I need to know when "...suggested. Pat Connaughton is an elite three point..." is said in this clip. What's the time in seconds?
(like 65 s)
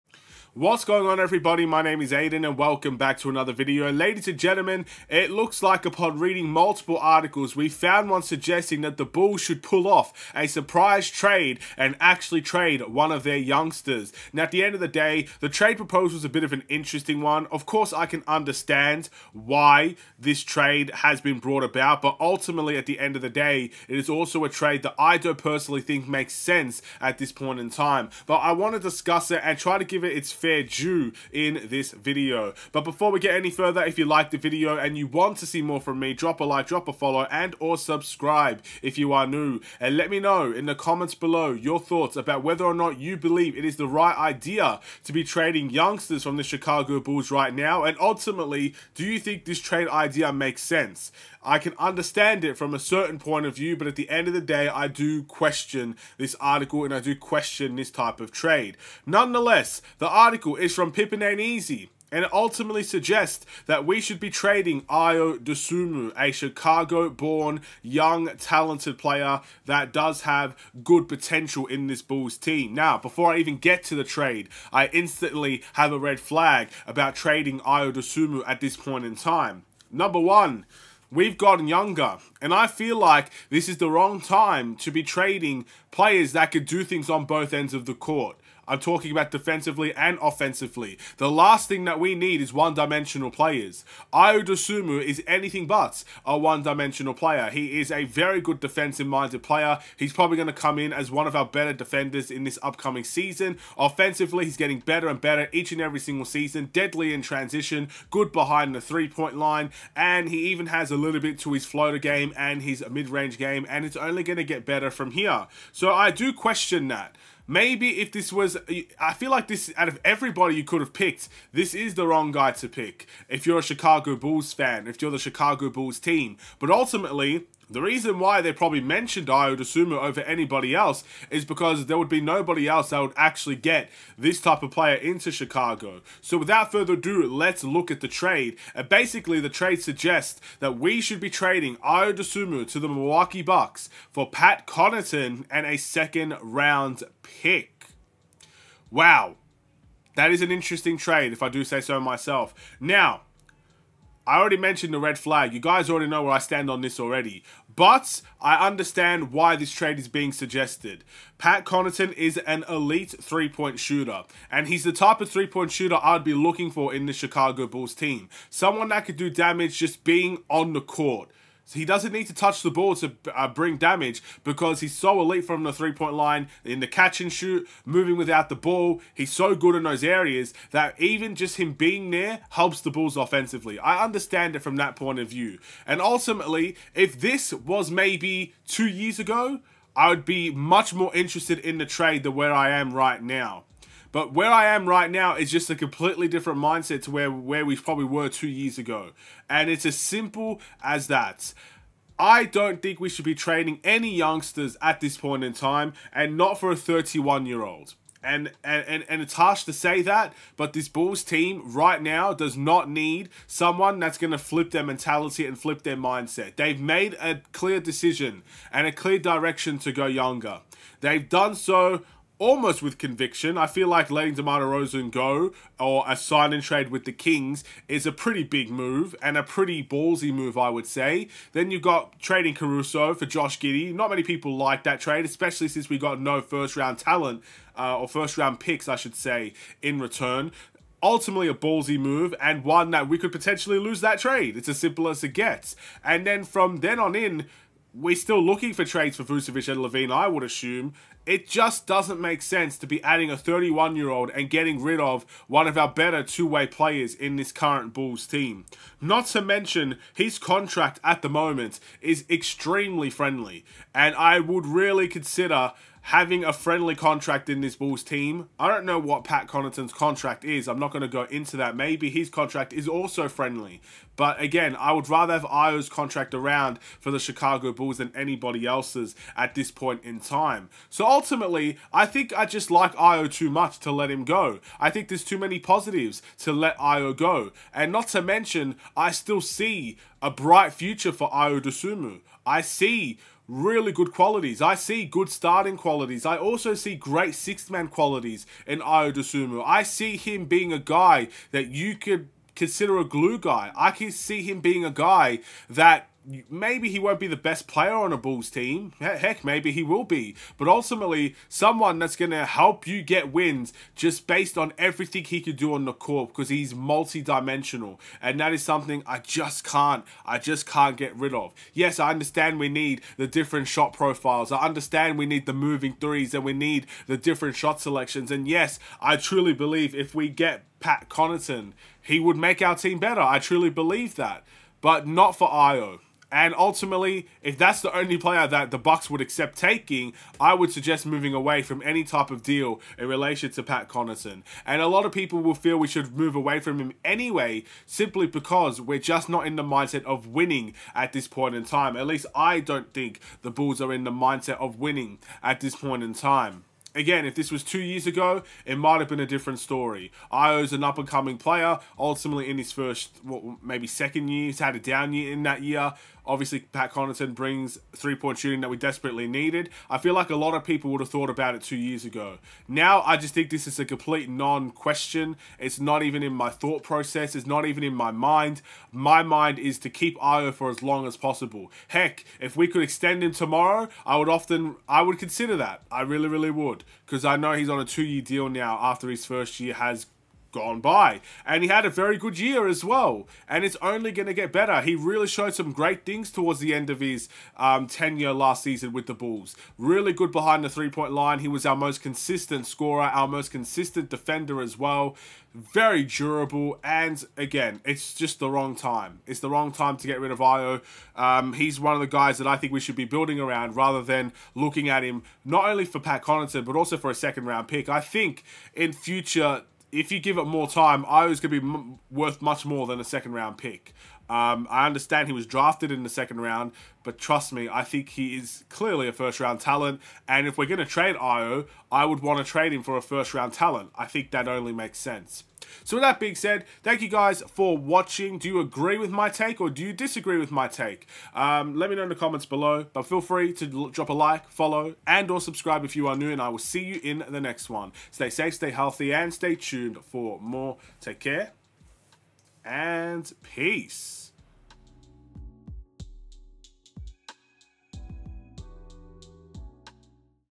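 160 s.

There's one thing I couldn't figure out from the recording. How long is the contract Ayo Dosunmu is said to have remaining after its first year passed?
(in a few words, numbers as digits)
2 years.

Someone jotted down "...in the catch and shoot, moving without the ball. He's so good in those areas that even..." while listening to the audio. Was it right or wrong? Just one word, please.
right.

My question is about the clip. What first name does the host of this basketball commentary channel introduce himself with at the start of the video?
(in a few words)
Aiden.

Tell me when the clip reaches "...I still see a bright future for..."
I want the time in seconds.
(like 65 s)
288 s.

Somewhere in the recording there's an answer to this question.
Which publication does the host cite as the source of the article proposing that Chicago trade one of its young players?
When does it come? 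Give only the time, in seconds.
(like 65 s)
60 s.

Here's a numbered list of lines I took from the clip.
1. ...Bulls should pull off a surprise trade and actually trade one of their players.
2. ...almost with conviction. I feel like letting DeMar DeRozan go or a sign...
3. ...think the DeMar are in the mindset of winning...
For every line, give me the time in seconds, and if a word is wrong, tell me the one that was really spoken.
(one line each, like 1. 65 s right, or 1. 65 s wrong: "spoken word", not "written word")
1. 9 s wrong: "youngsters", not "players"
2. 222 s right
3. 352 s wrong: "Bulls", not "DeMar".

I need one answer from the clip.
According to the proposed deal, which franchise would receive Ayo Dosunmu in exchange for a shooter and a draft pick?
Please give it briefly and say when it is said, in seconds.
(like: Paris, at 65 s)
Milwaukee Bucks, at 142 s.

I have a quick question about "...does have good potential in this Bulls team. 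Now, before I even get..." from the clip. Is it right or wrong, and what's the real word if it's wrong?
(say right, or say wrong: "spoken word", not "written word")
right.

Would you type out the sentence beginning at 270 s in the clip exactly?
I'm not going to go into that.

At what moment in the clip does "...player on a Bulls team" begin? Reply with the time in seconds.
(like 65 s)
307 s.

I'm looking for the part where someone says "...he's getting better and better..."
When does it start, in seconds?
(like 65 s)
104 s.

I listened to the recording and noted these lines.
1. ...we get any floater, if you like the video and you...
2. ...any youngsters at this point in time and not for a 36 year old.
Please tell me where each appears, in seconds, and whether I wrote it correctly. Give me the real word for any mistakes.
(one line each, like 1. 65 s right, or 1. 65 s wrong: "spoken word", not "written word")
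1. 33 s wrong: "further", not "floater"
2. 203 s wrong: "31", not "36".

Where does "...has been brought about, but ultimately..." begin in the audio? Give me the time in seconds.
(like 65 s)
20 s.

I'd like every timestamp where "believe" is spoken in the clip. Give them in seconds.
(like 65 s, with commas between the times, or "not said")
43 s, 329 s, 333 s.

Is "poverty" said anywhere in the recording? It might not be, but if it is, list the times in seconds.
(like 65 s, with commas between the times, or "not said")
not said.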